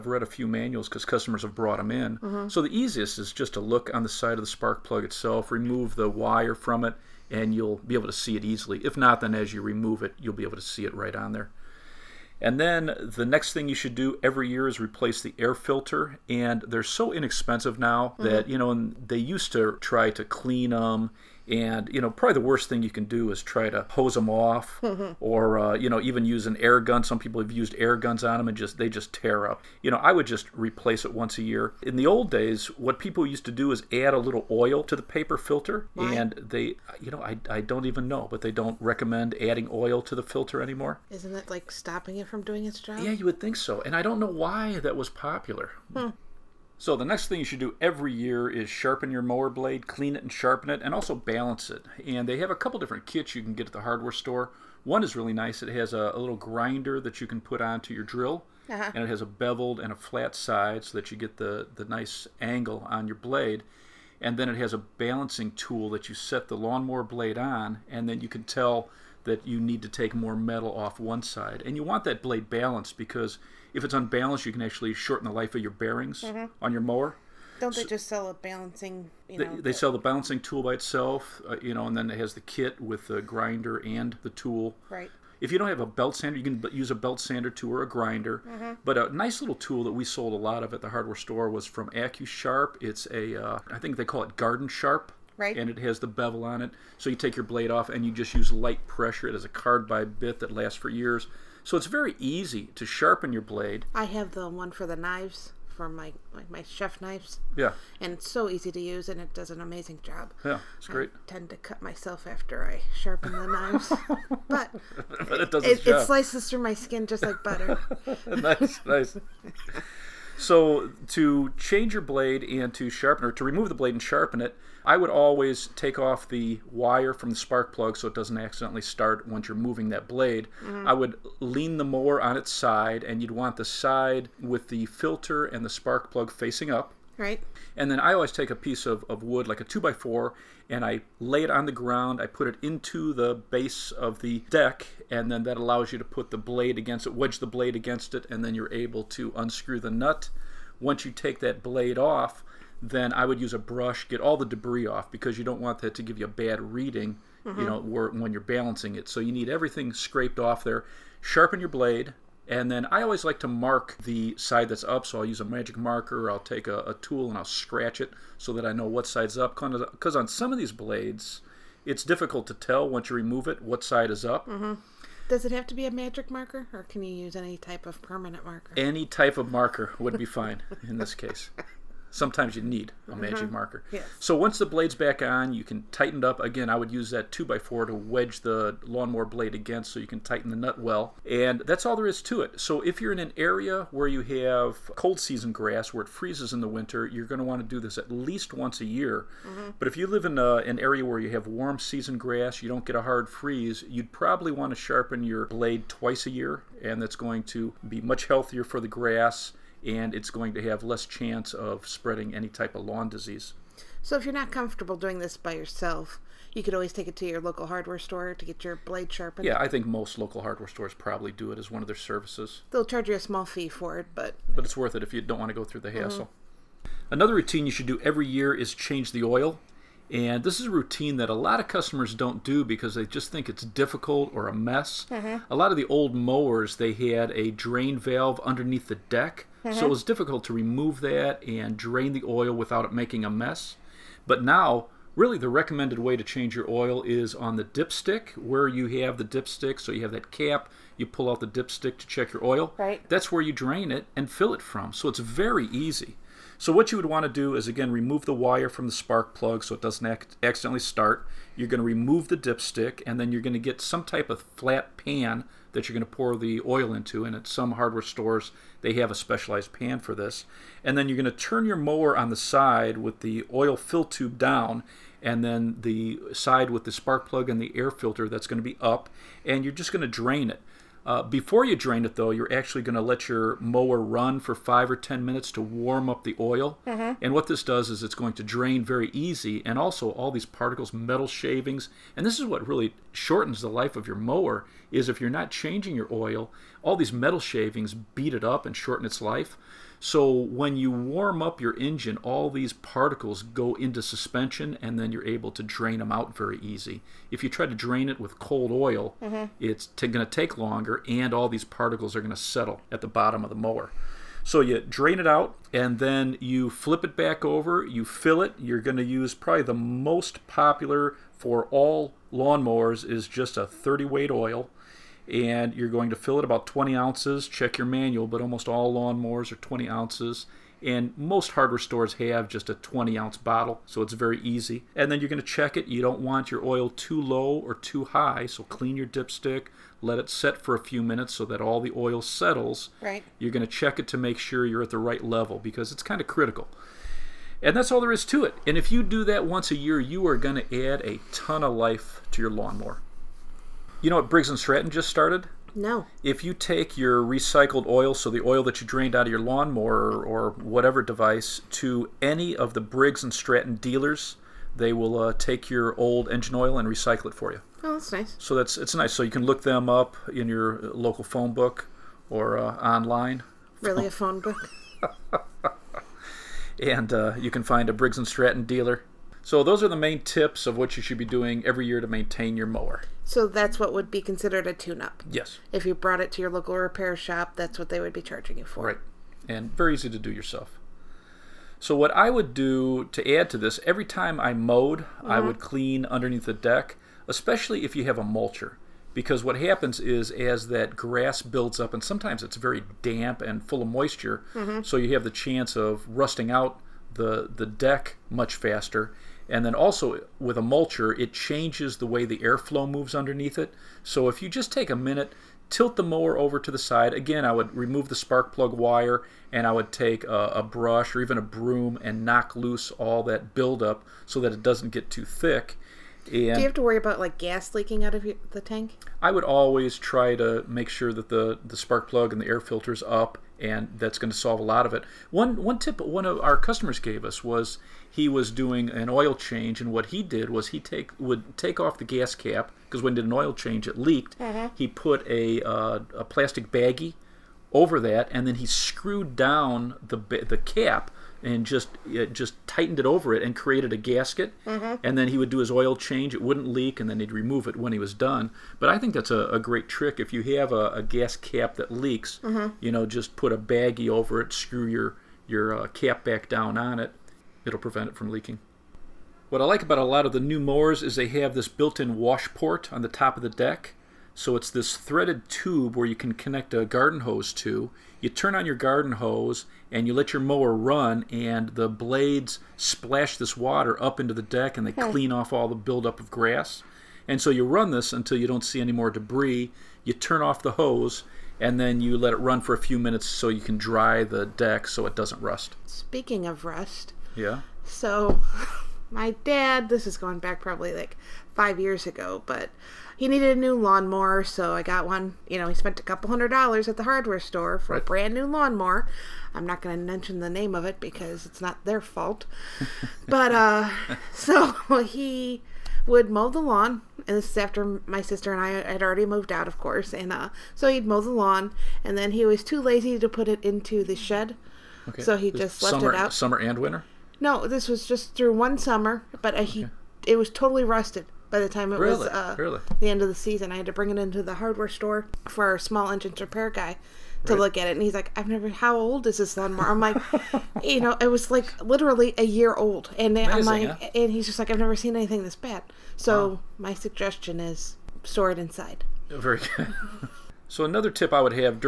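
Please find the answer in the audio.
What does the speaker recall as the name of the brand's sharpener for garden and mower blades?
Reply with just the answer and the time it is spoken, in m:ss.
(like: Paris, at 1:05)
Garden Sharp, at 1:34.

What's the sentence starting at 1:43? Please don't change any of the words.
I have the one for the knives for my like my chef knives.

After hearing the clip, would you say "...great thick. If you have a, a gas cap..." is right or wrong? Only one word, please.
wrong.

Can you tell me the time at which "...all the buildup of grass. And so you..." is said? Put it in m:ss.
8:05.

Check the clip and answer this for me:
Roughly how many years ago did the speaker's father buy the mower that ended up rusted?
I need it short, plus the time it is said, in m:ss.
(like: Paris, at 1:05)
5, at 8:21.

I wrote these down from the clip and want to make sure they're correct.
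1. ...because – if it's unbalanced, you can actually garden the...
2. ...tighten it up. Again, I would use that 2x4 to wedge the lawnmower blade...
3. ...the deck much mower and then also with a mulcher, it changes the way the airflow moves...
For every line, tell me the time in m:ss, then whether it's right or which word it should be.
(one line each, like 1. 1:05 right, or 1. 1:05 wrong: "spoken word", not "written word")
1. 1:12 wrong: "shorten", not "garden"
2. 3:05 right
3. 6:47 wrong: "faster", not "mower".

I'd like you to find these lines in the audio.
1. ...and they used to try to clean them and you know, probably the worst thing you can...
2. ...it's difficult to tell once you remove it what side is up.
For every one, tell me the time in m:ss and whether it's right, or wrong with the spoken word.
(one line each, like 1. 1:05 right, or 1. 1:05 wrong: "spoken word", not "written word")
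1. 0:18 right
2. 2:51 right.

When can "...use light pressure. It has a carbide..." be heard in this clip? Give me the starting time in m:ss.
1:38.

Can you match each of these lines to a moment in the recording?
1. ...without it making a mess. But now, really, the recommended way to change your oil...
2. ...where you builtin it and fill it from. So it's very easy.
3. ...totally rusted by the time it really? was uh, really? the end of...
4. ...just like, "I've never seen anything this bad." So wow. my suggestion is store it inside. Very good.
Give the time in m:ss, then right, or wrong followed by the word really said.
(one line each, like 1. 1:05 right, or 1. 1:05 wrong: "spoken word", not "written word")
1. 4:02 right
2. 4:13 wrong: "drain", not "builtin"
3. 8:50 right
4. 9:04 right.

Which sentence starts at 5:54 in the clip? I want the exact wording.
You know what Briggs and Stratton just started?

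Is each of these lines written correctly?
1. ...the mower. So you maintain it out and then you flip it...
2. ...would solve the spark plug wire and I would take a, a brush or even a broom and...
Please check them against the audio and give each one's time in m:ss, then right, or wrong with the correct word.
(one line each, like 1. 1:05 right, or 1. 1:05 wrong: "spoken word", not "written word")
1. 5:13 wrong: "drain", not "maintain"
2. 6:57 wrong: "remove", not "solve".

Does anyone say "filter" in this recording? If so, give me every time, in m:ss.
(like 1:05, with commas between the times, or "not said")
0:15, 0:35, 0:40, 2:14, 4:37, 7:12.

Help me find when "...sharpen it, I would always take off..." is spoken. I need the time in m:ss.
2:04.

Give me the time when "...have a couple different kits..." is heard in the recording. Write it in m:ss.
0:52.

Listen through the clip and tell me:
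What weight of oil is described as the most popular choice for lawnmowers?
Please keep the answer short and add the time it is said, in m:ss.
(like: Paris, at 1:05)
30 weight, at 5:23.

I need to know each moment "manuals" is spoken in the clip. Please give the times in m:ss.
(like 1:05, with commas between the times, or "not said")
0:00, 5:27.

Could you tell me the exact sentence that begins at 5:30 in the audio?
And most hardware stores have just a 20 ounce bottle, so it's very easy.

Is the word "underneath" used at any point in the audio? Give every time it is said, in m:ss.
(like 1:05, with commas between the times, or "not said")
3:58, 6:36, 6:53.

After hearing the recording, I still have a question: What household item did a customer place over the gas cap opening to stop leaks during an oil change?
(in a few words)
plastic baggie.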